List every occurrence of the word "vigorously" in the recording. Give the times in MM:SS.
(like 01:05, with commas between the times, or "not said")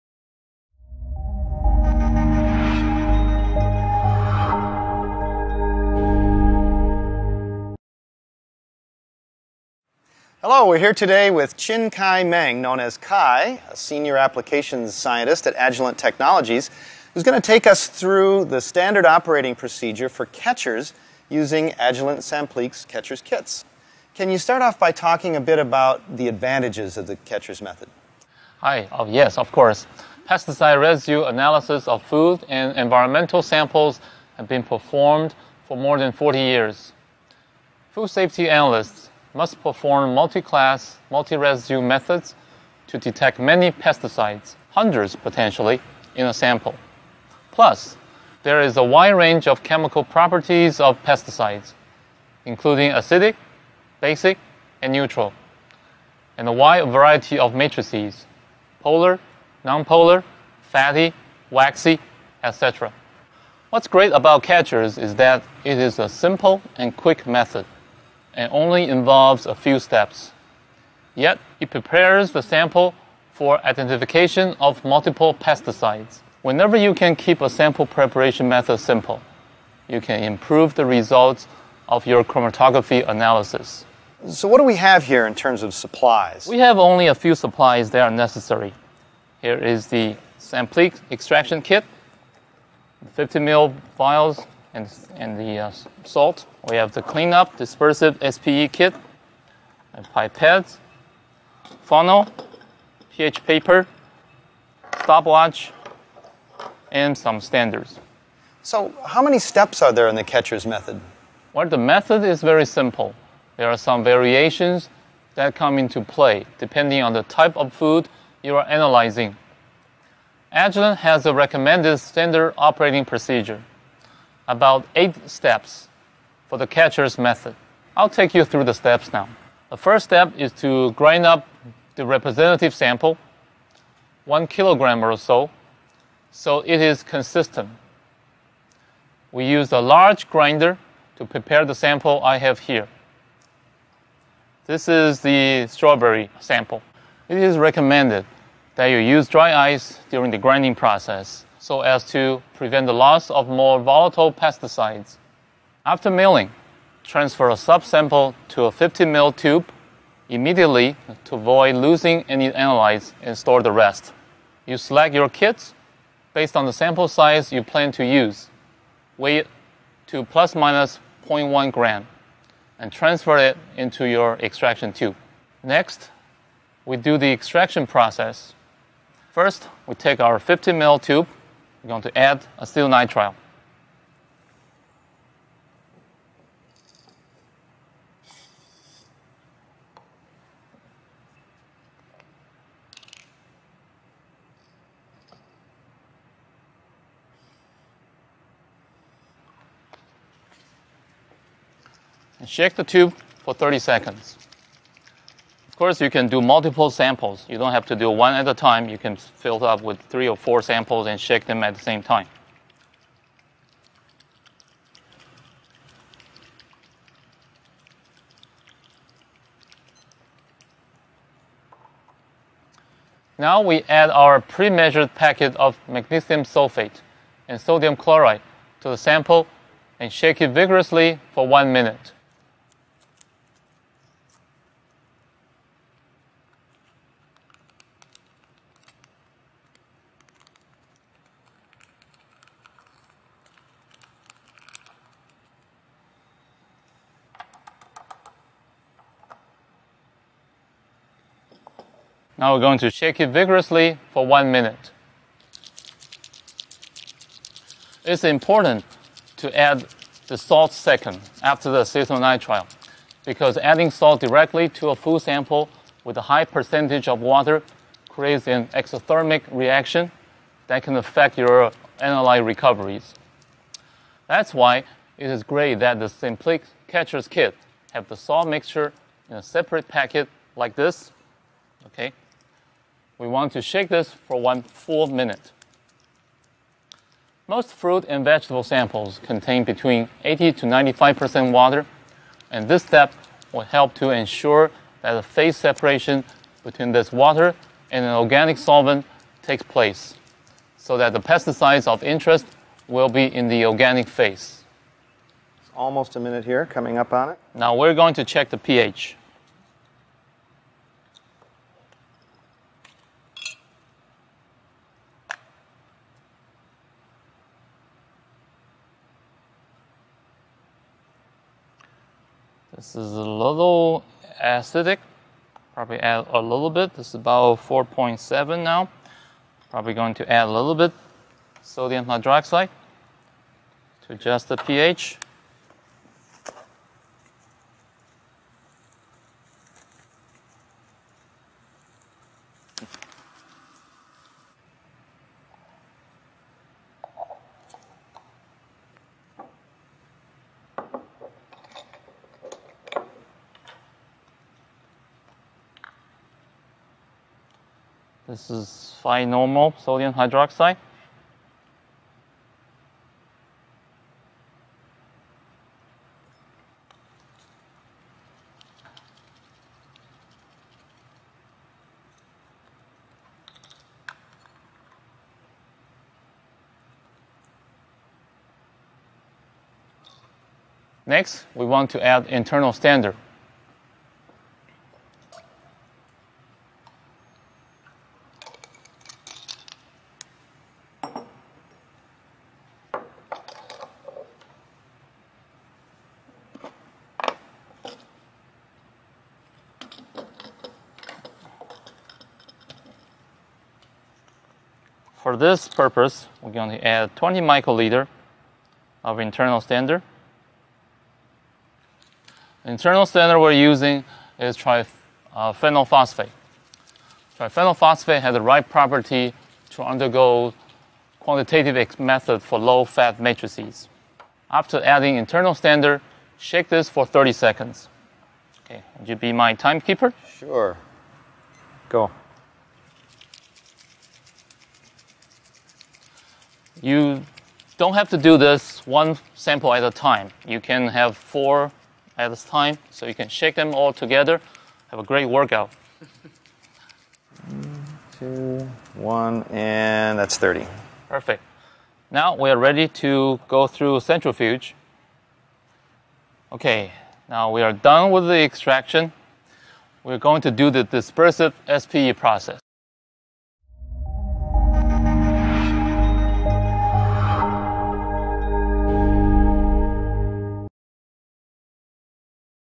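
03:50, 04:13.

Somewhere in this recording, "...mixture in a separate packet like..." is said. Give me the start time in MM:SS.
04:38.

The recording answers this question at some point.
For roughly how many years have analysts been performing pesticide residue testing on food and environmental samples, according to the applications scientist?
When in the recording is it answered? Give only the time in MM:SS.
00:35.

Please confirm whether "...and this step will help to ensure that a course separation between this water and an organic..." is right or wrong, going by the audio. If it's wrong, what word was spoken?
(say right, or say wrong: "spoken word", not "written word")
wrong: "phase", not "course".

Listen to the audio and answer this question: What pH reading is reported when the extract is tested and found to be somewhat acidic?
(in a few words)
4.7.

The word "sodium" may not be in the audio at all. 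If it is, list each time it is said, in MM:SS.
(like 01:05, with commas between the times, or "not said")
03:47, 05:31, 05:59.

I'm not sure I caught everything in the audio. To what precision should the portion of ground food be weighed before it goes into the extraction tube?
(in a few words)
plus or minus 0.1 gram.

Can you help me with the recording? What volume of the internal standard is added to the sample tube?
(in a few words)
20 microliters.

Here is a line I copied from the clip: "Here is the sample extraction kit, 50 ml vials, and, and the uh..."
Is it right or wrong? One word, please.
right.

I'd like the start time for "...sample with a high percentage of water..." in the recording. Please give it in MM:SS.
04:25.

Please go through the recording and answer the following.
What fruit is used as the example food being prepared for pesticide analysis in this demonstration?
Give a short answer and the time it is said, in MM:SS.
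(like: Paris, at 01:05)
strawberry, at 02:25.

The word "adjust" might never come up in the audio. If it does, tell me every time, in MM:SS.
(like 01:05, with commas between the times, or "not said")
05:34.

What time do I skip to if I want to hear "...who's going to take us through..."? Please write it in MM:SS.
00:17.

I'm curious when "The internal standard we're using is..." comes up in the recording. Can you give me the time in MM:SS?
06:52.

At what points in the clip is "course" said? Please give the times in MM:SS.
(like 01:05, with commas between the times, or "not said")
00:29, 03:25.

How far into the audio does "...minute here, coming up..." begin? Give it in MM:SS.
05:06.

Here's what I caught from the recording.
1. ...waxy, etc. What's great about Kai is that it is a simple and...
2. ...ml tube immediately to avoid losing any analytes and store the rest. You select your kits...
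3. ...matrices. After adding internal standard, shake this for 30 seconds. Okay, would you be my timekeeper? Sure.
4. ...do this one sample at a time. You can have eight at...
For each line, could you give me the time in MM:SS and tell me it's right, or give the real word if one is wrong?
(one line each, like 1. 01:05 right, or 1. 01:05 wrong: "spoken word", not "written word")
1. 01:01 wrong: "QuEChERS", not "Kai"
2. 02:39 right
3. 07:03 right
4. 07:18 wrong: "four", not "eight".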